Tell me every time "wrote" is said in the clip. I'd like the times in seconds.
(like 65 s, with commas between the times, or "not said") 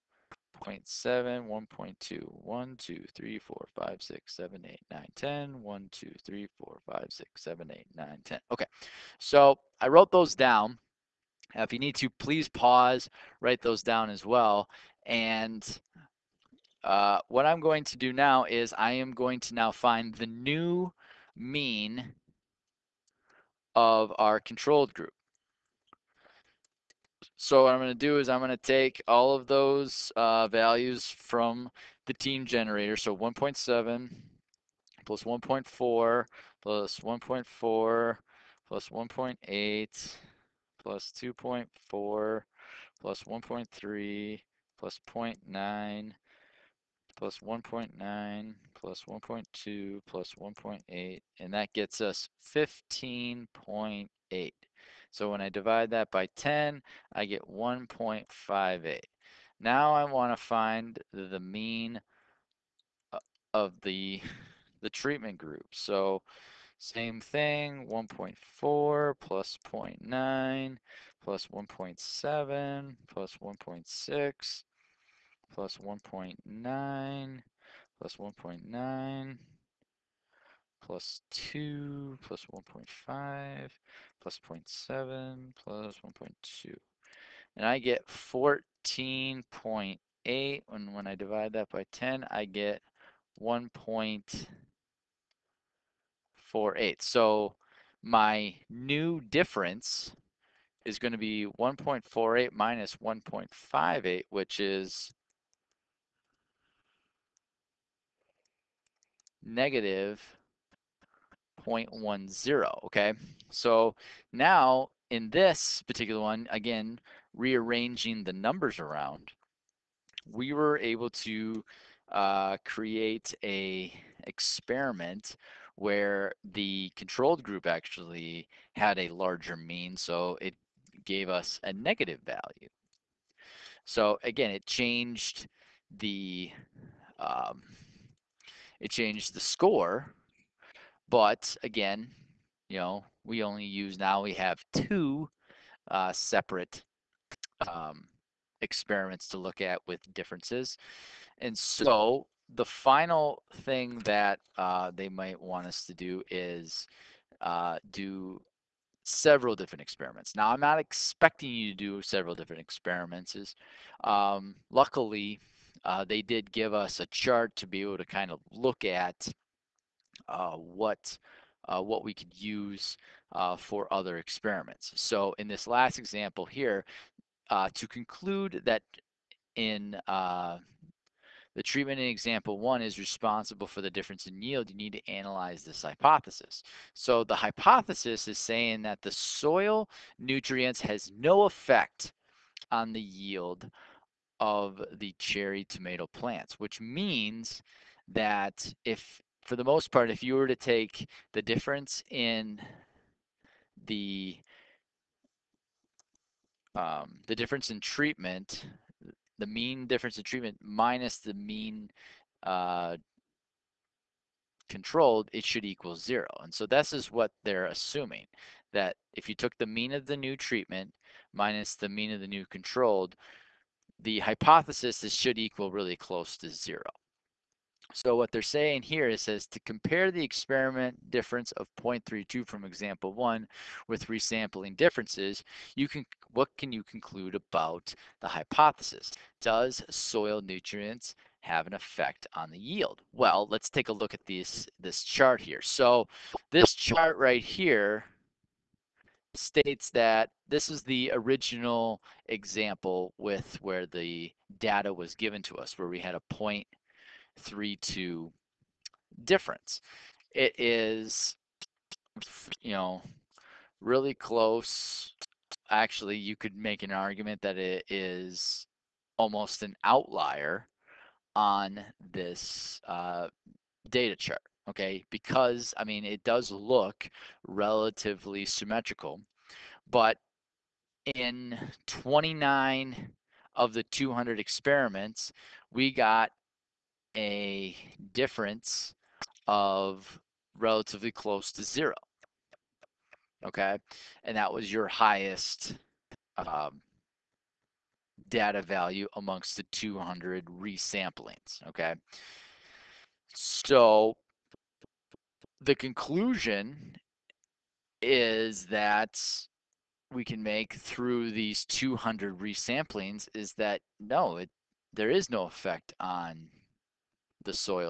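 9 s.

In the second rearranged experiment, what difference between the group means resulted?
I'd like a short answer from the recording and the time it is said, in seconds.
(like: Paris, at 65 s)
-0.10, at 109 s.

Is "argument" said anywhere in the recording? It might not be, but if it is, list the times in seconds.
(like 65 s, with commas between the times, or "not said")
266 s.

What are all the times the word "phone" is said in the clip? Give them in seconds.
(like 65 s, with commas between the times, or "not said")
not said.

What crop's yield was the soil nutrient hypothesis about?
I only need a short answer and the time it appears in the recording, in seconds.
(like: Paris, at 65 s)
cherry tomato plants, at 195 s.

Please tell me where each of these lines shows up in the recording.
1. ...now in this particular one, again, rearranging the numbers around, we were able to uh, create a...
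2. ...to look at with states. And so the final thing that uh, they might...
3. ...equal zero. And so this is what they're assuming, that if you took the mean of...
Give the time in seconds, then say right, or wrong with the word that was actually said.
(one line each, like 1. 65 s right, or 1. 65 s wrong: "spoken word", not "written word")
1. 114 s right
2. 149 s wrong: "differences", not "states"
3. 215 s right.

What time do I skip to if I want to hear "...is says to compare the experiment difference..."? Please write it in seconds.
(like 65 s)
229 s.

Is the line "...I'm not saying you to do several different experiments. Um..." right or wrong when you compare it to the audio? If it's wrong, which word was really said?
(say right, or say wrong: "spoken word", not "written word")
wrong: "expecting", not "saying".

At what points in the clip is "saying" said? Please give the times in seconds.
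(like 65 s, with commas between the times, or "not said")
188 s, 228 s.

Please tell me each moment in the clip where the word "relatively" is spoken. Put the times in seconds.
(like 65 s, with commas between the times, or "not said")
277 s, 290 s.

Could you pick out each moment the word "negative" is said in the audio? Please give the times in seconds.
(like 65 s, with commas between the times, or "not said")
109 s, 131 s.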